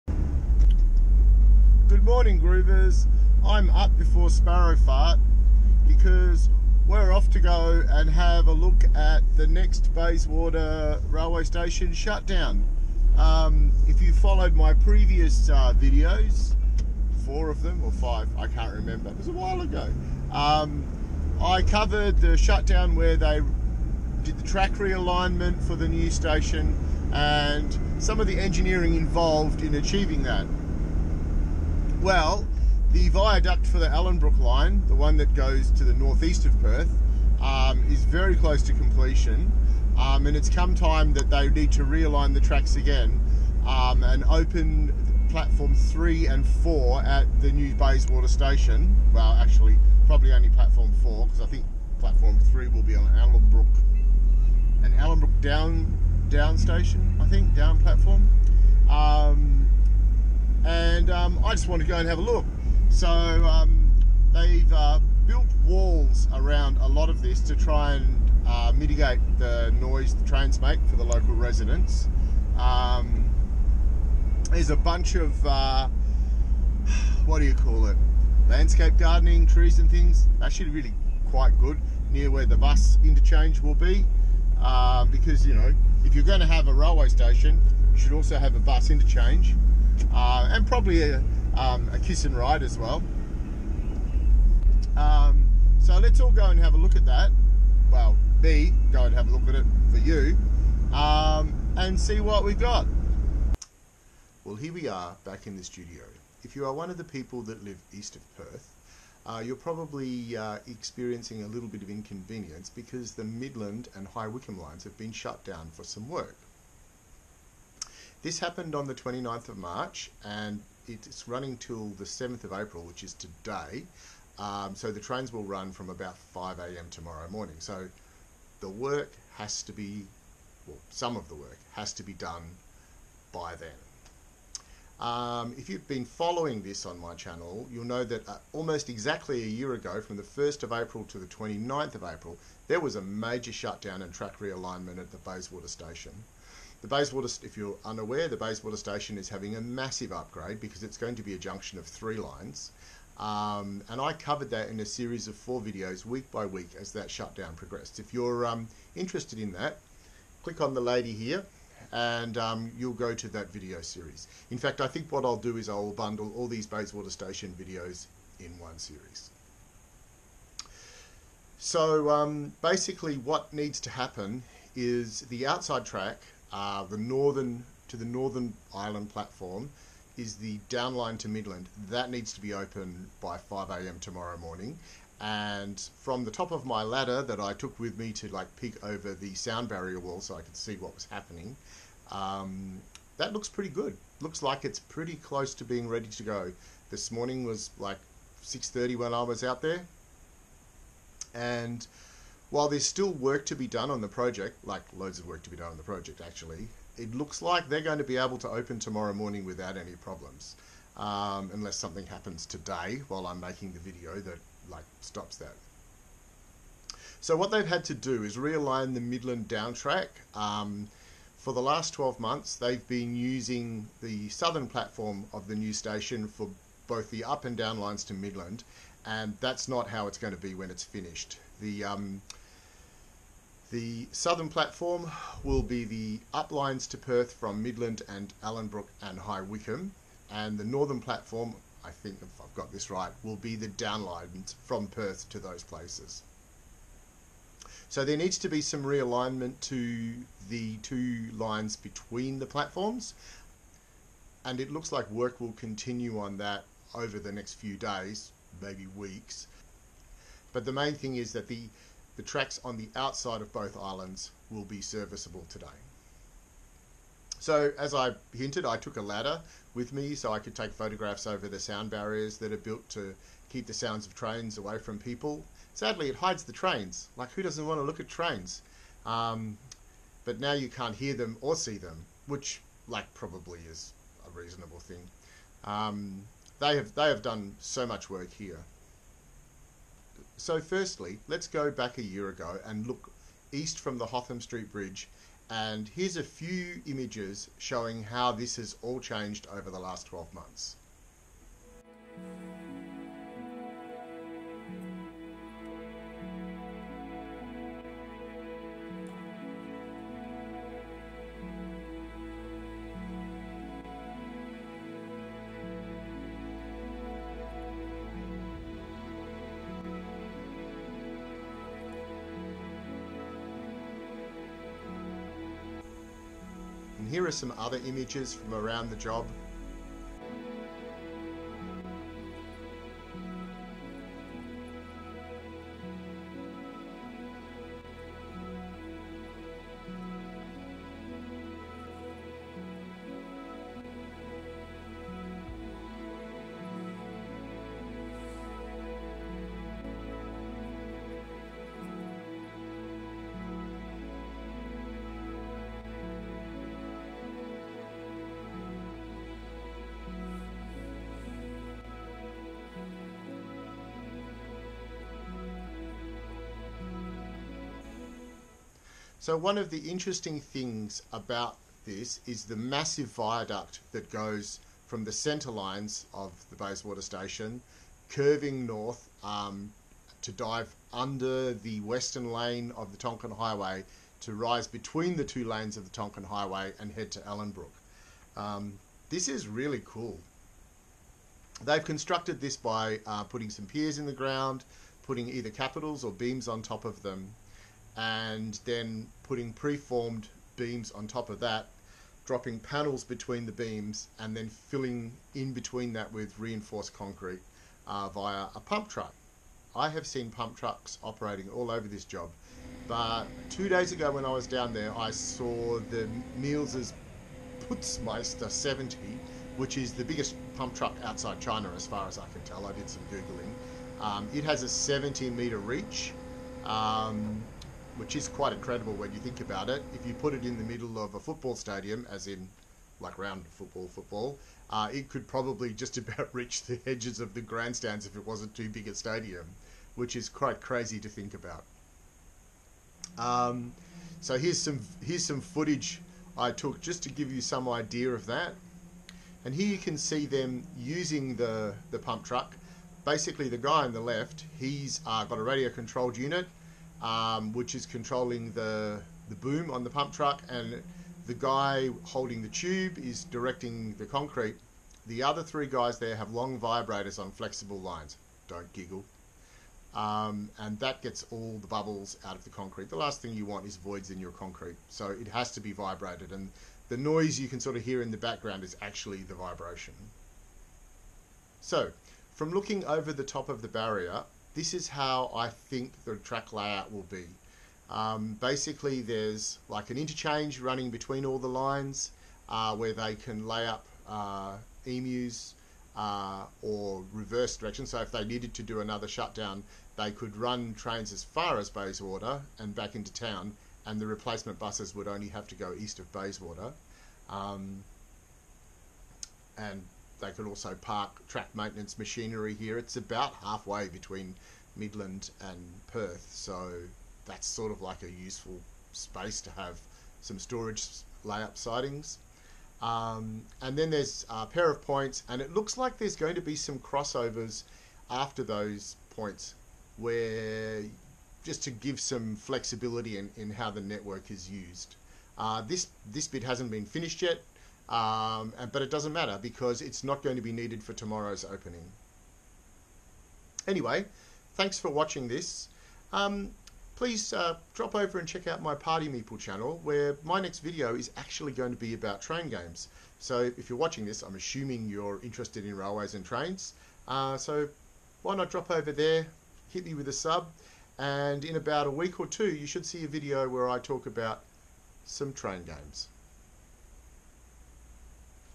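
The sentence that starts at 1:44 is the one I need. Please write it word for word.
Well, here we are back in the studio.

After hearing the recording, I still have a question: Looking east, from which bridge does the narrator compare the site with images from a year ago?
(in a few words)
Hotham Street Bridge.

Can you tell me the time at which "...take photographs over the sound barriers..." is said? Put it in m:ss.
4:30.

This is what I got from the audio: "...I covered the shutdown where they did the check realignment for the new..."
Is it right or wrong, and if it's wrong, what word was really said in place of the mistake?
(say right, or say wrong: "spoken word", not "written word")
wrong: "track", not "check".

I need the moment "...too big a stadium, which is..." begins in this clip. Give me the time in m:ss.
7:18.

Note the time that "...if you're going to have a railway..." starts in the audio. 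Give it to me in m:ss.
1:26.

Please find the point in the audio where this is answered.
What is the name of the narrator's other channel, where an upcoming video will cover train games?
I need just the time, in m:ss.
9:08.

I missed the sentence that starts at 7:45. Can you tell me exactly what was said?
The other three guys there have long vibrators on flexible lines.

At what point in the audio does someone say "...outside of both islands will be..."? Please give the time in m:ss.
4:22.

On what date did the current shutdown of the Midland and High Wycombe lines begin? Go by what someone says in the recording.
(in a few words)
29th of March.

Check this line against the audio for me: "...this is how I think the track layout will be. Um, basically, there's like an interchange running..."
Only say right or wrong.
right.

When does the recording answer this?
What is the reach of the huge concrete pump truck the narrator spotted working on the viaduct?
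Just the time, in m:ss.
7:04.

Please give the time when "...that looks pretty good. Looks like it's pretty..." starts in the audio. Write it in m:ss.
3:13.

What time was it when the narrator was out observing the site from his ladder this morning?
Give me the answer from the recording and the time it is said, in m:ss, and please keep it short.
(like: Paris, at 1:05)
6:30, at 3:18.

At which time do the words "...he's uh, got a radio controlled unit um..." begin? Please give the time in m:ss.
7:34.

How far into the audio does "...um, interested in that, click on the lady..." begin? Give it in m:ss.
2:38.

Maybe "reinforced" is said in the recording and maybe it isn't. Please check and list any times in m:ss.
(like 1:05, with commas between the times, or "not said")
6:46.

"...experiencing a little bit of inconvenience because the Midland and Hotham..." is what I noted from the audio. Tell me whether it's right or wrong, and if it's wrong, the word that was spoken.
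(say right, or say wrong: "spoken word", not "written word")
wrong: "High", not "Hotham".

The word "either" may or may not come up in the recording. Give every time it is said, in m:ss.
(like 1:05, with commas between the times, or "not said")
6:35.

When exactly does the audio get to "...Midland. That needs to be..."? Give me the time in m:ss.
3:01.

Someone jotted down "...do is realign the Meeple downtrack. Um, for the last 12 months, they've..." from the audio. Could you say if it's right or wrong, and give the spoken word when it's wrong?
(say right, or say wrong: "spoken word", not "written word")
wrong: "Midland", not "Meeple".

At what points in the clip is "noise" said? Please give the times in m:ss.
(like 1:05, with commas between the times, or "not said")
1:09, 7:56.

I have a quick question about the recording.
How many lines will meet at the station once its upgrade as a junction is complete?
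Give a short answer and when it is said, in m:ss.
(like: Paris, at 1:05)
3, at 2:31.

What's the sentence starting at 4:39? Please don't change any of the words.
Um, but now you can't hear them or see them, which, like, probably is a reasonable thing.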